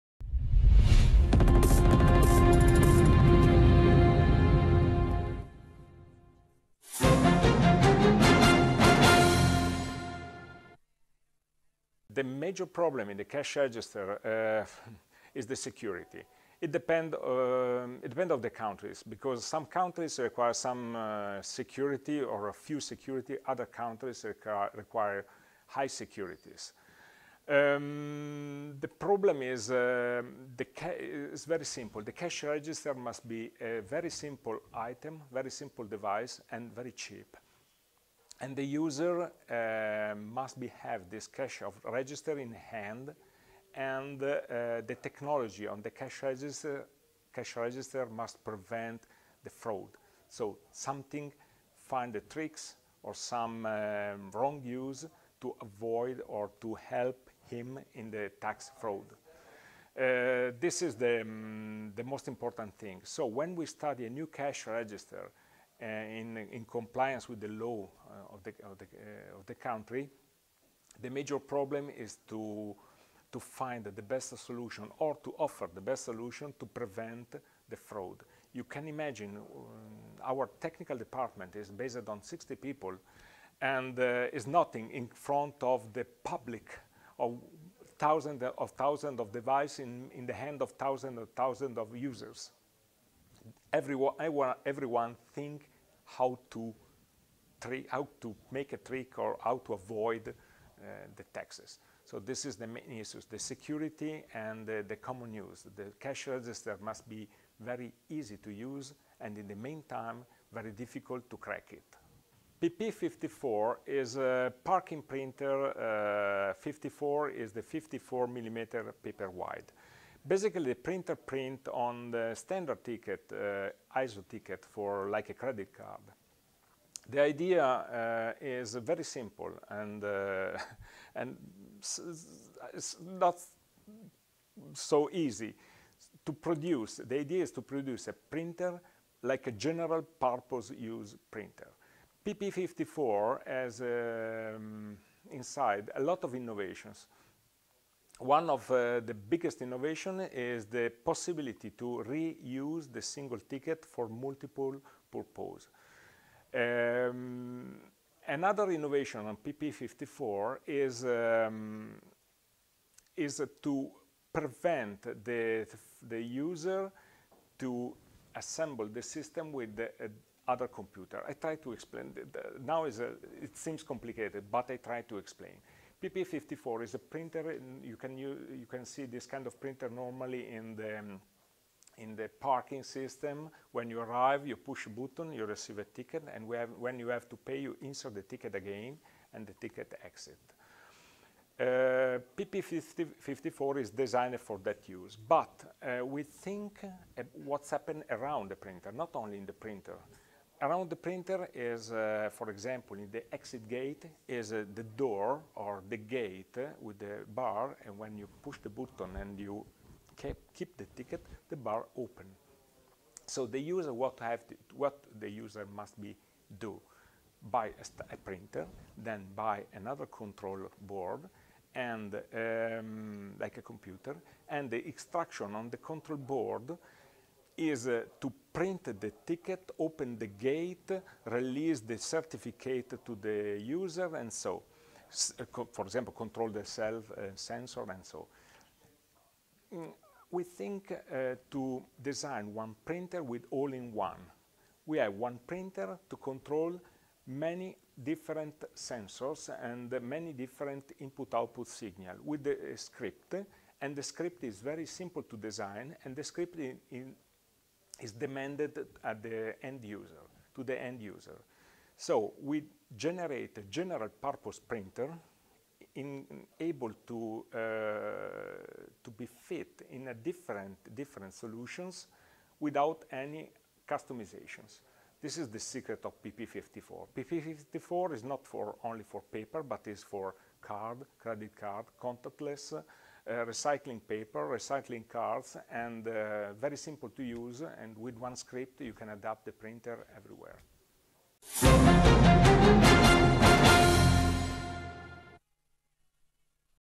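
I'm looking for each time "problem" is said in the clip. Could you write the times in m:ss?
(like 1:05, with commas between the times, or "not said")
0:12, 0:28, 1:11.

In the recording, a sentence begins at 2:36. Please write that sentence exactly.
Um, another innovation on PP54 is, um, is to prevent the, the user to assemble the system with the uh, other computer.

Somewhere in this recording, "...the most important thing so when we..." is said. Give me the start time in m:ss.
1:01.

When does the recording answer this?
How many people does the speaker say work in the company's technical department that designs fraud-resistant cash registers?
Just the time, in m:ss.
1:22.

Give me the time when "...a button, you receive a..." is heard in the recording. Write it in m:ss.
3:04.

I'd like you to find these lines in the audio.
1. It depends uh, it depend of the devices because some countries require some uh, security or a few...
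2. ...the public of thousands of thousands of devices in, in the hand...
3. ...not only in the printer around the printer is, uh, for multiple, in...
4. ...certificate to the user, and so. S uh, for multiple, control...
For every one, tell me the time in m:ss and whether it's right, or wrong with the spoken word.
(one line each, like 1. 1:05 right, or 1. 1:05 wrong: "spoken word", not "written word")
1. 0:16 wrong: "countries", not "devices"
2. 1:25 right
3. 3:18 wrong: "example", not "multiple"
4. 3:51 wrong: "example", not "multiple".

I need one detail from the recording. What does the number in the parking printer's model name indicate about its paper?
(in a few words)
54 millimeter paper width.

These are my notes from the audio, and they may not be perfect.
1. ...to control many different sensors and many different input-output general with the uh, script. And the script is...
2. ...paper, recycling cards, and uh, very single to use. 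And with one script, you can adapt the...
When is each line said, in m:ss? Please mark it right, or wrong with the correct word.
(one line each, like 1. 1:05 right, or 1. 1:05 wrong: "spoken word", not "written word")
1. 4:06 wrong: "signal", not "general"
2. 4:44 wrong: "simple", not "single".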